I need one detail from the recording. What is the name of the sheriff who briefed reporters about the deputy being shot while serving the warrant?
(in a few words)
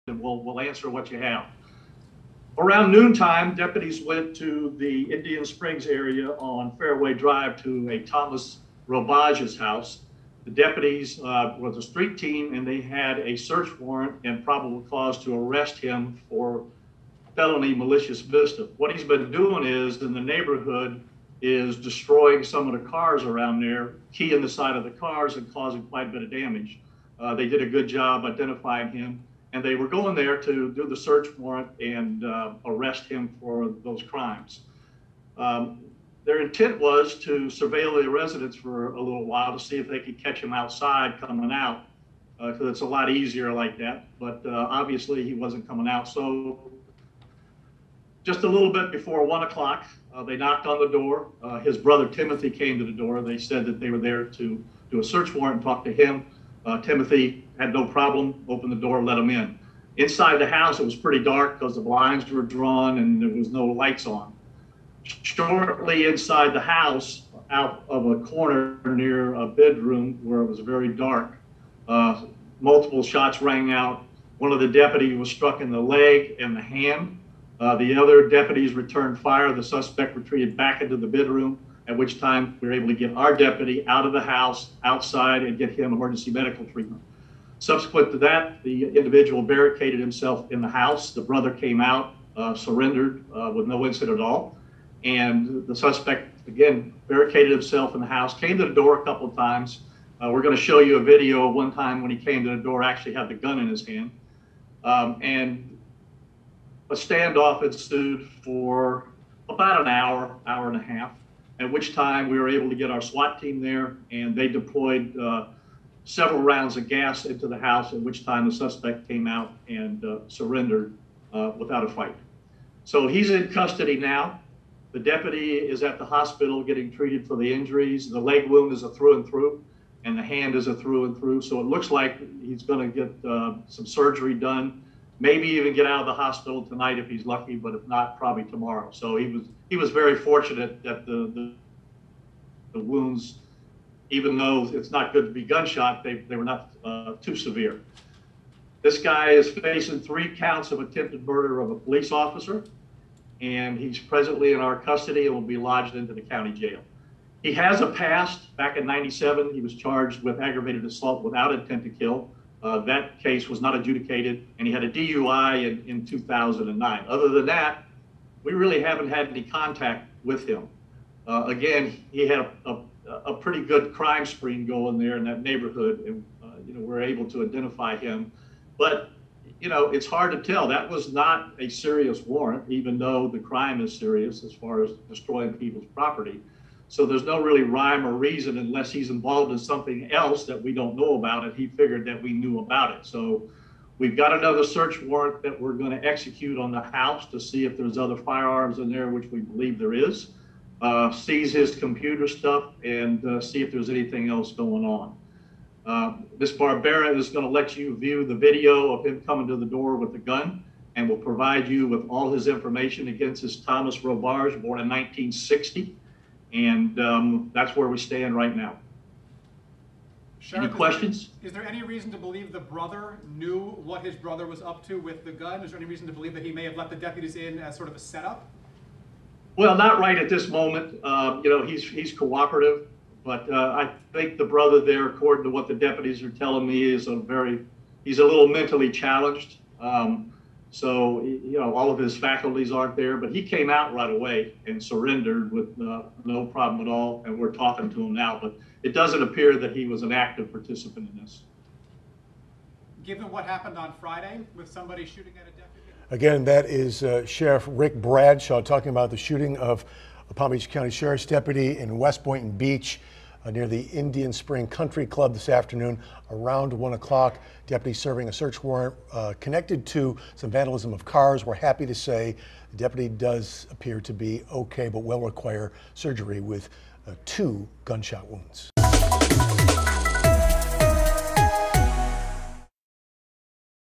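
Rick Bradshaw.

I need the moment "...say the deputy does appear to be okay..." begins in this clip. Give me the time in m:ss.
4:31.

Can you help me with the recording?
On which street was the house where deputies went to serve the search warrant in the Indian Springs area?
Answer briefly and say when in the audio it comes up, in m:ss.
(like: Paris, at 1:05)
Fairway Drive, at 0:06.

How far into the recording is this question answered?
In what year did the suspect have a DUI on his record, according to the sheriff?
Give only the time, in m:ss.
2:46.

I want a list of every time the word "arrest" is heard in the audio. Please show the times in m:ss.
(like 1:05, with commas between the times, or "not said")
0:15, 0:32.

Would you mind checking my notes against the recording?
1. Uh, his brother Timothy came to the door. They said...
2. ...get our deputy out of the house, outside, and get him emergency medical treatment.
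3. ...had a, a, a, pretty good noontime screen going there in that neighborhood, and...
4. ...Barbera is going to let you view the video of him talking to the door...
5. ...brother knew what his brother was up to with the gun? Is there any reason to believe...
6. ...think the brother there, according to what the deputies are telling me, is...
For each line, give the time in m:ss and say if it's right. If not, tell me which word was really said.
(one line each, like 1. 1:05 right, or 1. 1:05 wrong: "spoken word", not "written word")
1. 0:51 right
2. 1:22 right
3. 2:52 wrong: "crime", not "noontime"
4. 3:26 wrong: "coming", not "talking"
5. 3:42 right
6. 3:54 right.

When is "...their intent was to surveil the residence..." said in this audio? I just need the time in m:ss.
0:36.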